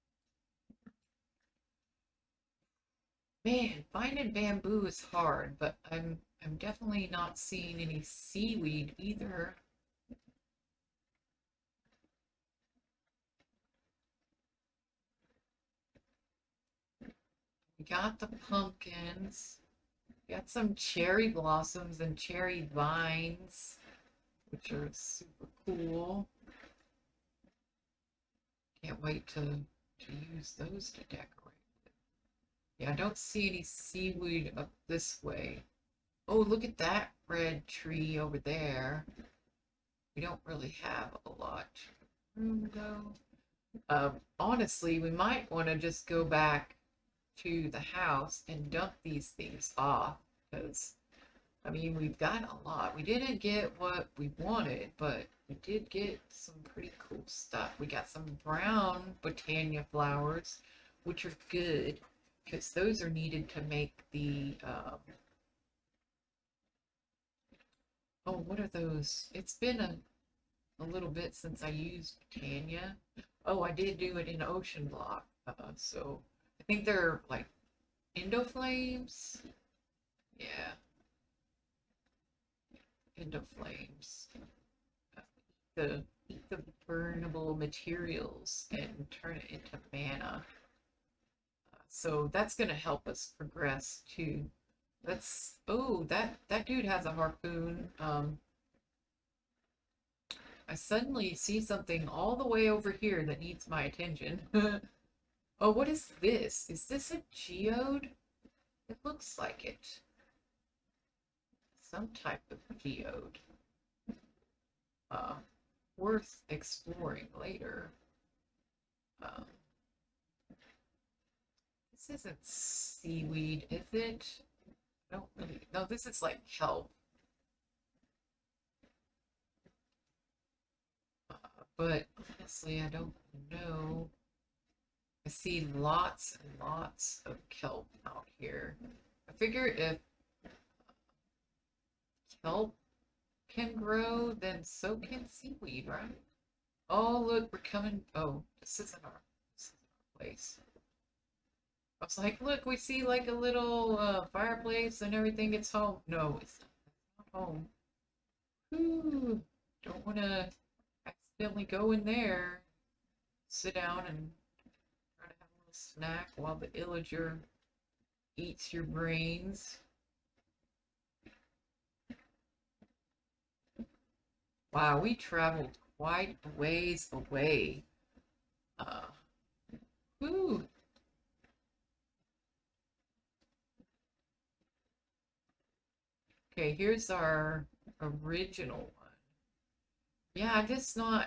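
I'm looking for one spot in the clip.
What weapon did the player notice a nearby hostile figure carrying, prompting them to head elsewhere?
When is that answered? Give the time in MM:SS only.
01:37.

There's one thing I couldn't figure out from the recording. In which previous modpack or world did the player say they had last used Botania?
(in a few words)
Ocean Block.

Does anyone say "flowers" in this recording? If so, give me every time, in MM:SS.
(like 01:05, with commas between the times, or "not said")
00:59.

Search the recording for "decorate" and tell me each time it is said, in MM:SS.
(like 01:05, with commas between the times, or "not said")
00:31.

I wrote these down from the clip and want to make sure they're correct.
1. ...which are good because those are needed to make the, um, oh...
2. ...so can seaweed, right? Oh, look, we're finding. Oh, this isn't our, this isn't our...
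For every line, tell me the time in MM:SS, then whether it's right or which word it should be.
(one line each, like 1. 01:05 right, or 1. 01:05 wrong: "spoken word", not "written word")
1. 01:01 right
2. 02:24 wrong: "coming", not "finding".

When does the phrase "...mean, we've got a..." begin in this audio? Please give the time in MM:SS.
00:51.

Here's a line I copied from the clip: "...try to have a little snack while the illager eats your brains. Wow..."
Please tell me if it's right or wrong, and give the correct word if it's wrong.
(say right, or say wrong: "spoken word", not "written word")
right.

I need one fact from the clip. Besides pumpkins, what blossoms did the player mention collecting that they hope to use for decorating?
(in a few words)
Cherry blossoms.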